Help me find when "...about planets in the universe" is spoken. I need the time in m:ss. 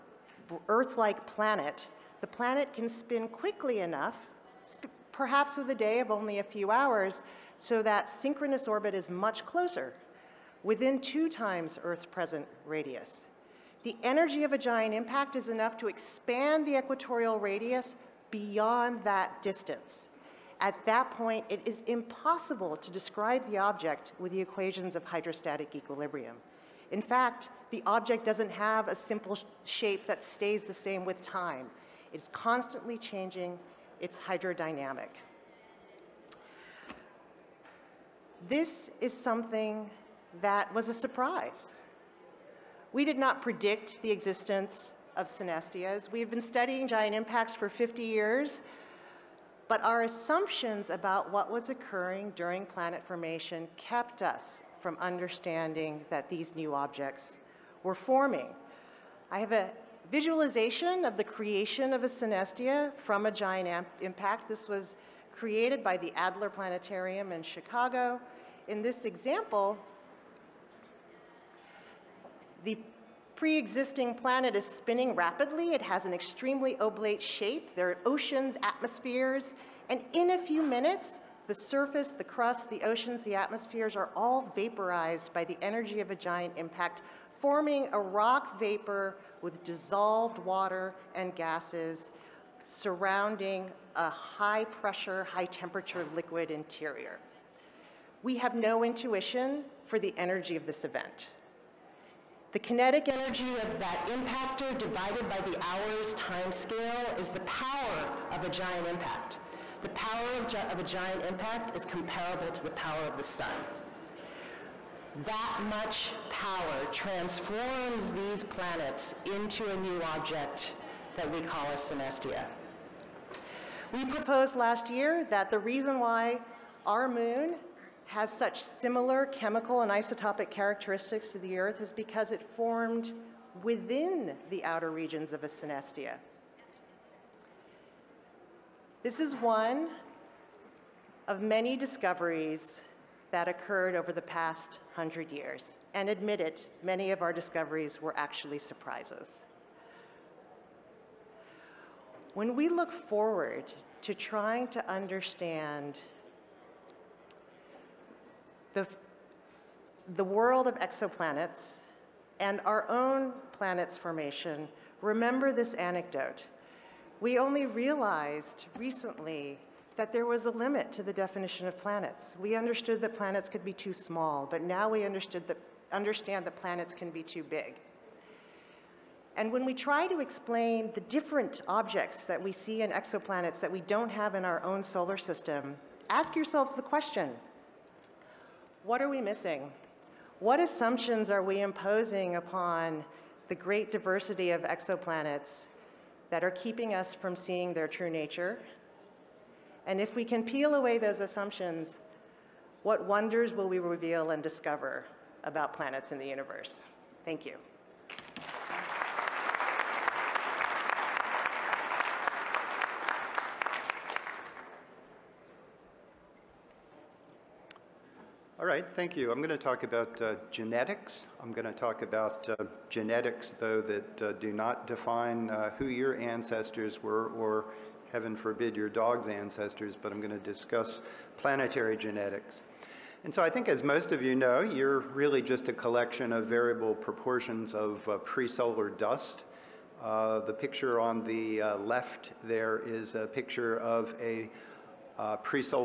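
3:25.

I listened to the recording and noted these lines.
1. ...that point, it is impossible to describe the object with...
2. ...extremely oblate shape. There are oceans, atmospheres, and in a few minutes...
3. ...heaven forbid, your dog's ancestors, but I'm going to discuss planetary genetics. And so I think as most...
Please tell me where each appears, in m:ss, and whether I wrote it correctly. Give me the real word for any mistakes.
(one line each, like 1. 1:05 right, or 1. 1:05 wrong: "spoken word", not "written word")
1. 0:20 right
2. 1:16 right
3. 3:48 right.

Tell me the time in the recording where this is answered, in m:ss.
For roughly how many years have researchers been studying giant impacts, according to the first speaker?
0:47.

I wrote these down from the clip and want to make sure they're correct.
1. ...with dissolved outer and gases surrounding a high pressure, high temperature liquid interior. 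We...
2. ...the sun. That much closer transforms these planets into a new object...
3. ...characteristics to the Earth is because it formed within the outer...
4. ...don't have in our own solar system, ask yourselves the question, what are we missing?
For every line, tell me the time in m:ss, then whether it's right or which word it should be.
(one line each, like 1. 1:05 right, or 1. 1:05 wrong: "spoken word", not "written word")
1. 1:29 wrong: "water", not "outer"
2. 1:53 wrong: "power", not "closer"
3. 2:10 right
4. 3:03 right.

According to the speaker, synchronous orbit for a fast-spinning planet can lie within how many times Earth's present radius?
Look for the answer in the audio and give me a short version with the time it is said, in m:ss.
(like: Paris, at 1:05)
2, at 0:10.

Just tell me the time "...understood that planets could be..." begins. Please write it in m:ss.
2:52.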